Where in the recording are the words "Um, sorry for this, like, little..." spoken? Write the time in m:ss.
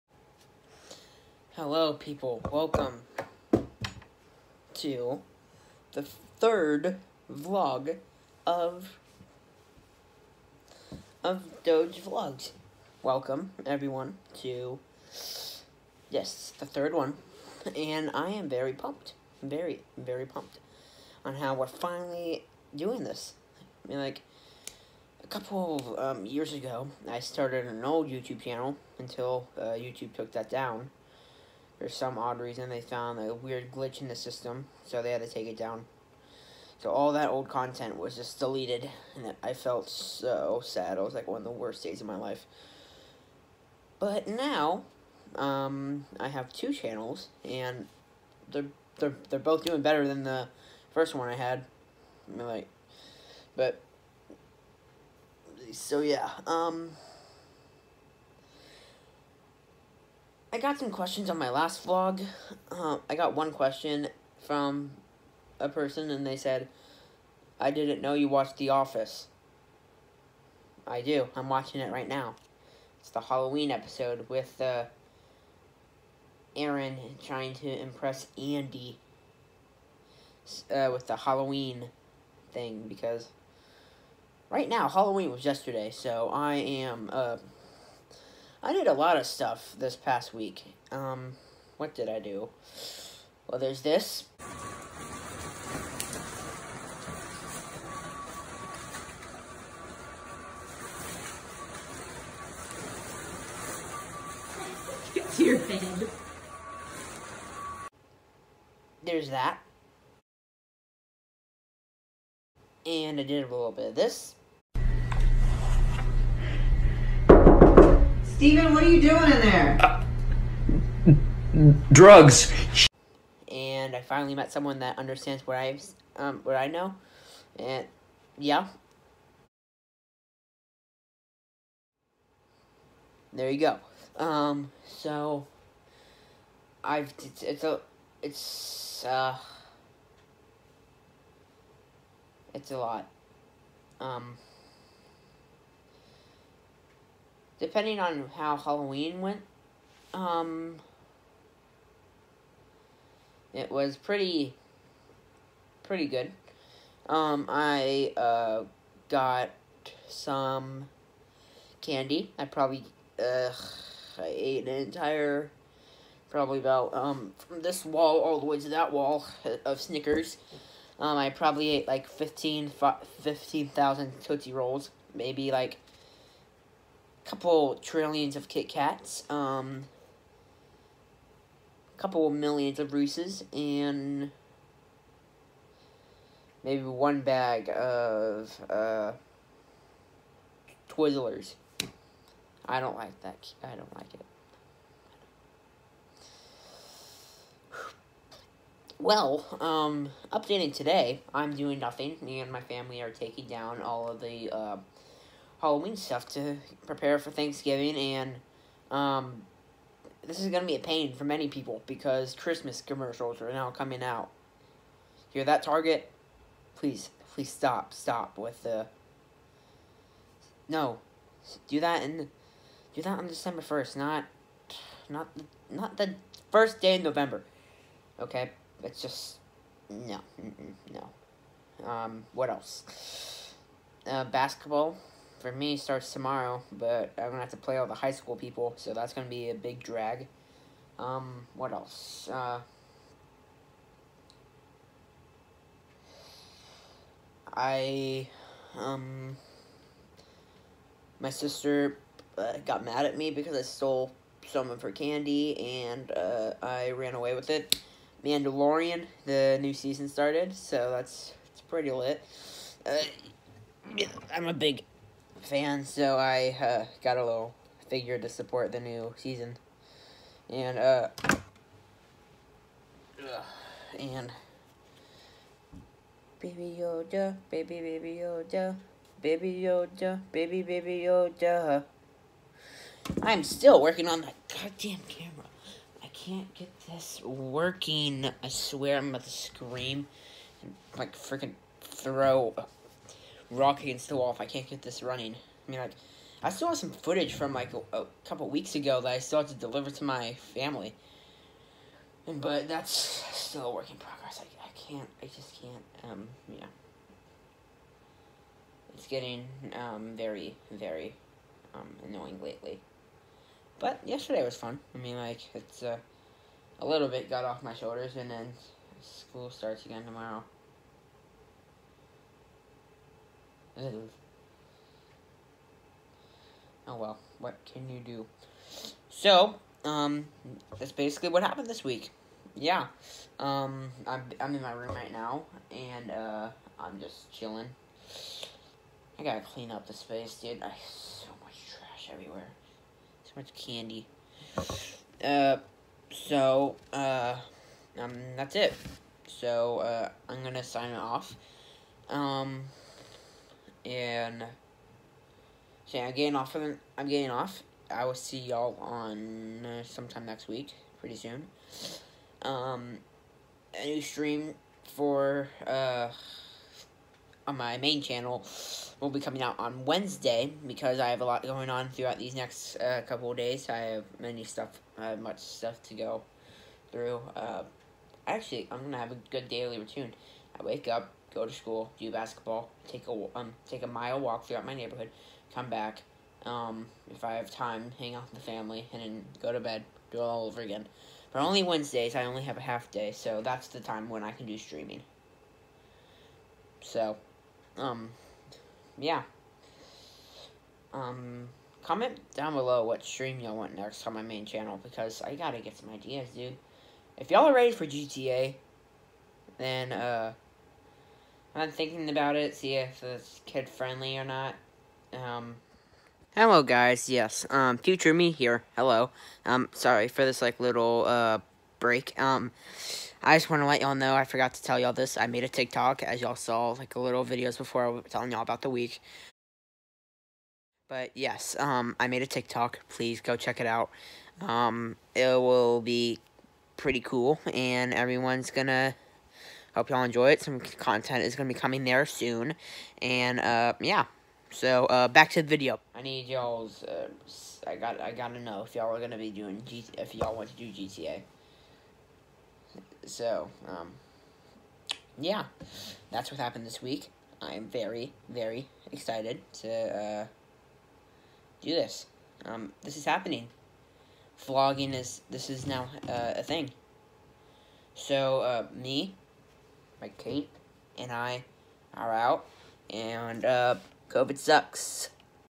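6:59.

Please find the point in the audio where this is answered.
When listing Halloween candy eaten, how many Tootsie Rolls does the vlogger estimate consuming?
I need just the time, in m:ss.
2:53.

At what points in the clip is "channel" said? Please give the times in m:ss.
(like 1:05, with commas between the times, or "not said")
0:28, 0:46, 6:08, 6:44.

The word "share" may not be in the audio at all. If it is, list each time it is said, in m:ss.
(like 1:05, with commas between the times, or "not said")
not said.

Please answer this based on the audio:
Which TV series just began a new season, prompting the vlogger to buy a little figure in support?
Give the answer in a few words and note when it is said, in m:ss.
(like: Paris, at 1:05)
Mandalorian, at 4:18.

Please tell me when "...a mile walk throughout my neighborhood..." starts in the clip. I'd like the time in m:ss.
6:23.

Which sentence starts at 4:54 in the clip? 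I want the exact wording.
If I can't get this running.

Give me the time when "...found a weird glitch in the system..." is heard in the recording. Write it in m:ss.
0:32.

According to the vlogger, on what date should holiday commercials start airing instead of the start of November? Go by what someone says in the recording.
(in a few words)
December 1st.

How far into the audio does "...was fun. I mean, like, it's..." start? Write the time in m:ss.
5:14.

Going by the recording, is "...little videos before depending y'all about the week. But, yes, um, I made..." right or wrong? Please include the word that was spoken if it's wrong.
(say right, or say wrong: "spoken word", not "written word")
wrong: "telling", not "depending".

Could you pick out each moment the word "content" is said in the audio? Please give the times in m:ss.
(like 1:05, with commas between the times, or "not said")
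0:37, 7:20.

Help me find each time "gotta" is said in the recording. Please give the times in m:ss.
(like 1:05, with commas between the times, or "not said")
5:39, 6:45, 7:28.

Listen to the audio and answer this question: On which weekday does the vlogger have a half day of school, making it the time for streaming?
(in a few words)
Wednesday.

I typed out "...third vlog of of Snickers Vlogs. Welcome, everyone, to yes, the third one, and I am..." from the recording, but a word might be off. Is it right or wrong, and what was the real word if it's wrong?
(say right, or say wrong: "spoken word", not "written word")
wrong: "Doge", not "Snickers".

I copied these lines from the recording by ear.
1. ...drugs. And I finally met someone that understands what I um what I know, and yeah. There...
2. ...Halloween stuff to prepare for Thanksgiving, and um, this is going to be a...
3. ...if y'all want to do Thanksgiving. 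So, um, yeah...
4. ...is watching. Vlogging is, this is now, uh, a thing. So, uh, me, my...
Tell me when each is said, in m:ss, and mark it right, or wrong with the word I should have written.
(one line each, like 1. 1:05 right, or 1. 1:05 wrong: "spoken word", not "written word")
1. 2:01 right
2. 3:25 right
3. 7:29 wrong: "GTA", not "Thanksgiving"
4. 7:42 wrong: "happening", not "watching".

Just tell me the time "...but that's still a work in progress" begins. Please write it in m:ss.
5:02.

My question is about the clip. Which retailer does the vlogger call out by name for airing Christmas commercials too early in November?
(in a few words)
Target.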